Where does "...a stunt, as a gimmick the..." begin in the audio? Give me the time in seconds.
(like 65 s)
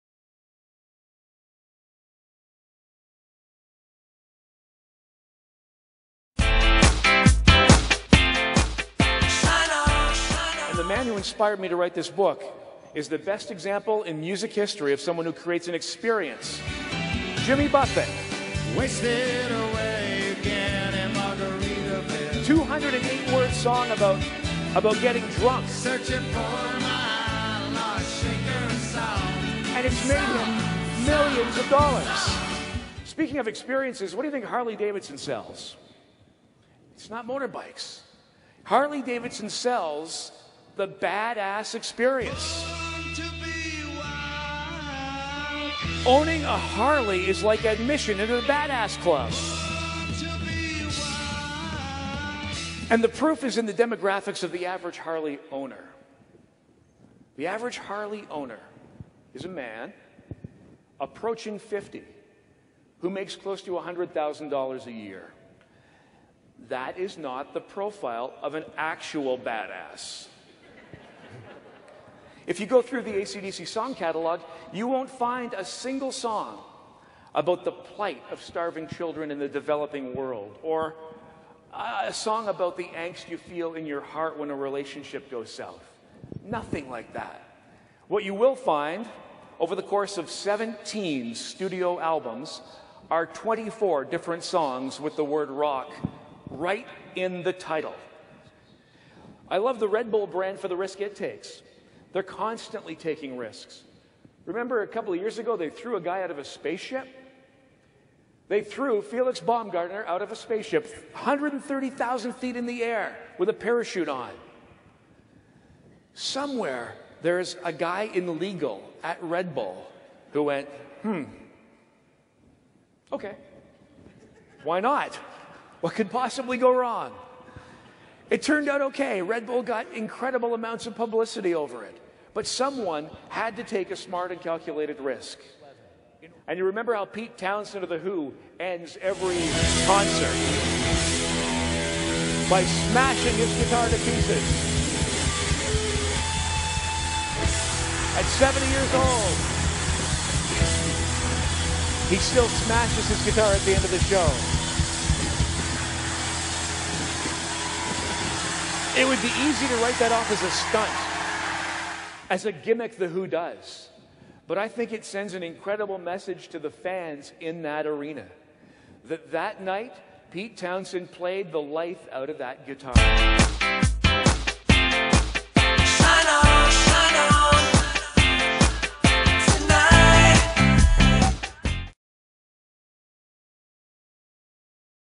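160 s.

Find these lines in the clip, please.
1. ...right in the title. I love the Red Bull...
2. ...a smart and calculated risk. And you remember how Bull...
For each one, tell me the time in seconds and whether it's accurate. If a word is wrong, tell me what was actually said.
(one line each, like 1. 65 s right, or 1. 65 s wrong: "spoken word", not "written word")
1. 96 s right
2. 133 s wrong: "Pete", not "Bull".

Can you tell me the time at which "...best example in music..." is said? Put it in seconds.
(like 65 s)
13 s.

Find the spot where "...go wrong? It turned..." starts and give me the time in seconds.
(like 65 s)
126 s.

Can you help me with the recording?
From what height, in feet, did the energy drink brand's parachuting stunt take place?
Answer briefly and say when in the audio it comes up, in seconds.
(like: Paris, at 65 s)
130,000 feet, at 111 s.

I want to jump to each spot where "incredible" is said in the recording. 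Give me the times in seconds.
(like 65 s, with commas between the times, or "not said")
129 s, 165 s.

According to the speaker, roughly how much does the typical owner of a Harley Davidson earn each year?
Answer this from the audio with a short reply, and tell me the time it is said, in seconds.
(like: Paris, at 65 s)
$100,000, at 63 s.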